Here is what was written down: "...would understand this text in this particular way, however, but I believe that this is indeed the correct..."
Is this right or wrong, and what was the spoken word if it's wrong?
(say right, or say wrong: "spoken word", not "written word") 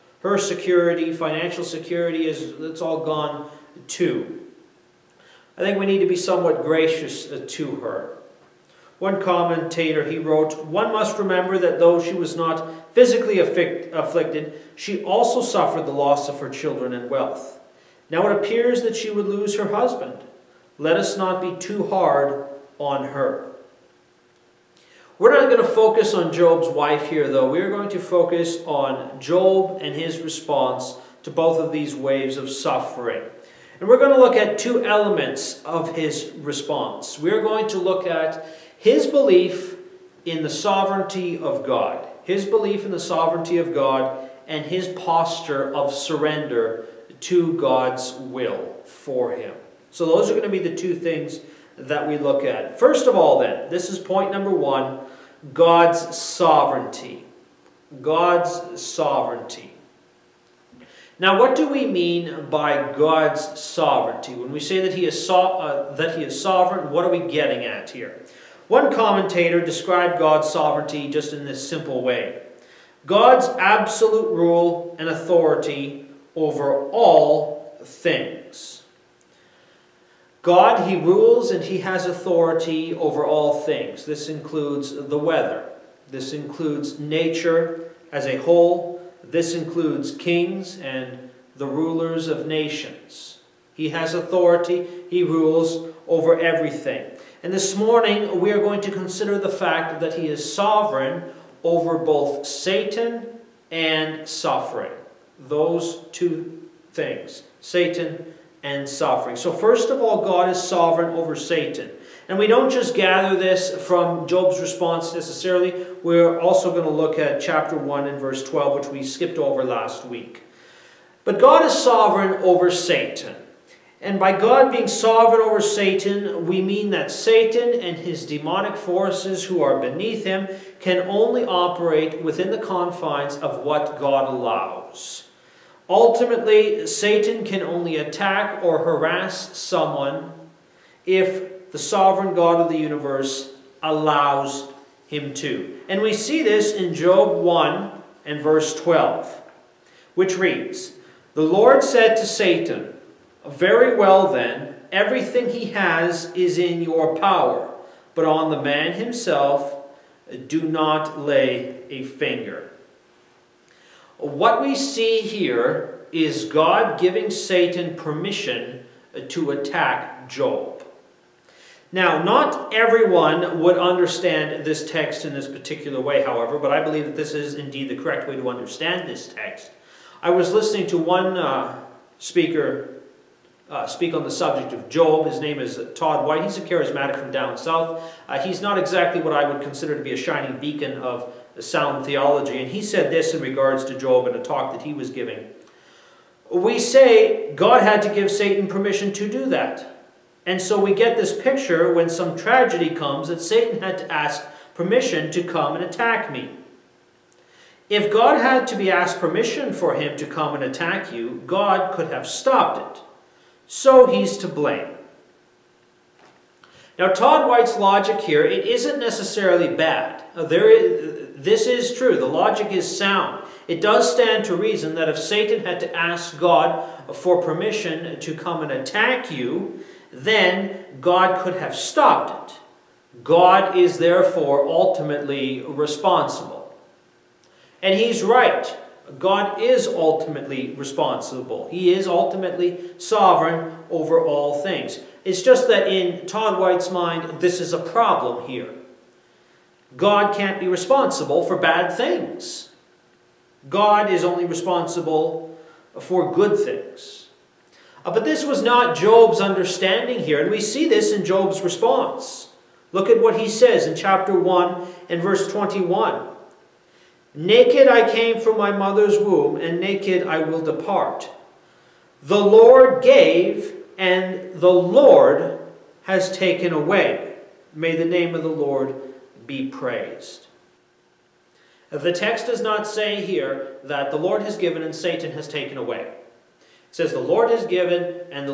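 right.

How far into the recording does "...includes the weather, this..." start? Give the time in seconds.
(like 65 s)
84 s.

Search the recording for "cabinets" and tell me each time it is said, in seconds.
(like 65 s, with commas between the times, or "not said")
not said.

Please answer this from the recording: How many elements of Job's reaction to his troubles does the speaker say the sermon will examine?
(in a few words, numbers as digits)
2.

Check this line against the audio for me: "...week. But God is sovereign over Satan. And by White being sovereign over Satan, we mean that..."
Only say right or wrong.
wrong.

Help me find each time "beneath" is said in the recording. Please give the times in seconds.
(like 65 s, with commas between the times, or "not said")
129 s.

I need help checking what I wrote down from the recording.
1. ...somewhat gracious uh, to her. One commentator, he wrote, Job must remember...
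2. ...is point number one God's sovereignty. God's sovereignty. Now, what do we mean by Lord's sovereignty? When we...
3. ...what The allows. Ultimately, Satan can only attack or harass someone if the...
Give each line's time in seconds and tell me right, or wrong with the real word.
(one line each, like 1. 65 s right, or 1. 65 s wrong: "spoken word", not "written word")
1. 6 s wrong: "One", not "Job"
2. 53 s wrong: "God", not "Lord"
3. 133 s wrong: "God", not "The".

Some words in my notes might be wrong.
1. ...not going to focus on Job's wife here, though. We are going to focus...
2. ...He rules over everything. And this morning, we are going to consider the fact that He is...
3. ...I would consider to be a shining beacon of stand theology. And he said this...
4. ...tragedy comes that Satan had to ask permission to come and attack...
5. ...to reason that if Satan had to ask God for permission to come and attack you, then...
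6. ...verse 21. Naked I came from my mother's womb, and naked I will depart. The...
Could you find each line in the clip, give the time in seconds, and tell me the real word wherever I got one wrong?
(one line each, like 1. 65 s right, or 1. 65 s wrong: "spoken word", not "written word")
1. 25 s right
2. 95 s right
3. 189 s wrong: "sound", not "stand"
4. 202 s right
5. 224 s right
6. 265 s right.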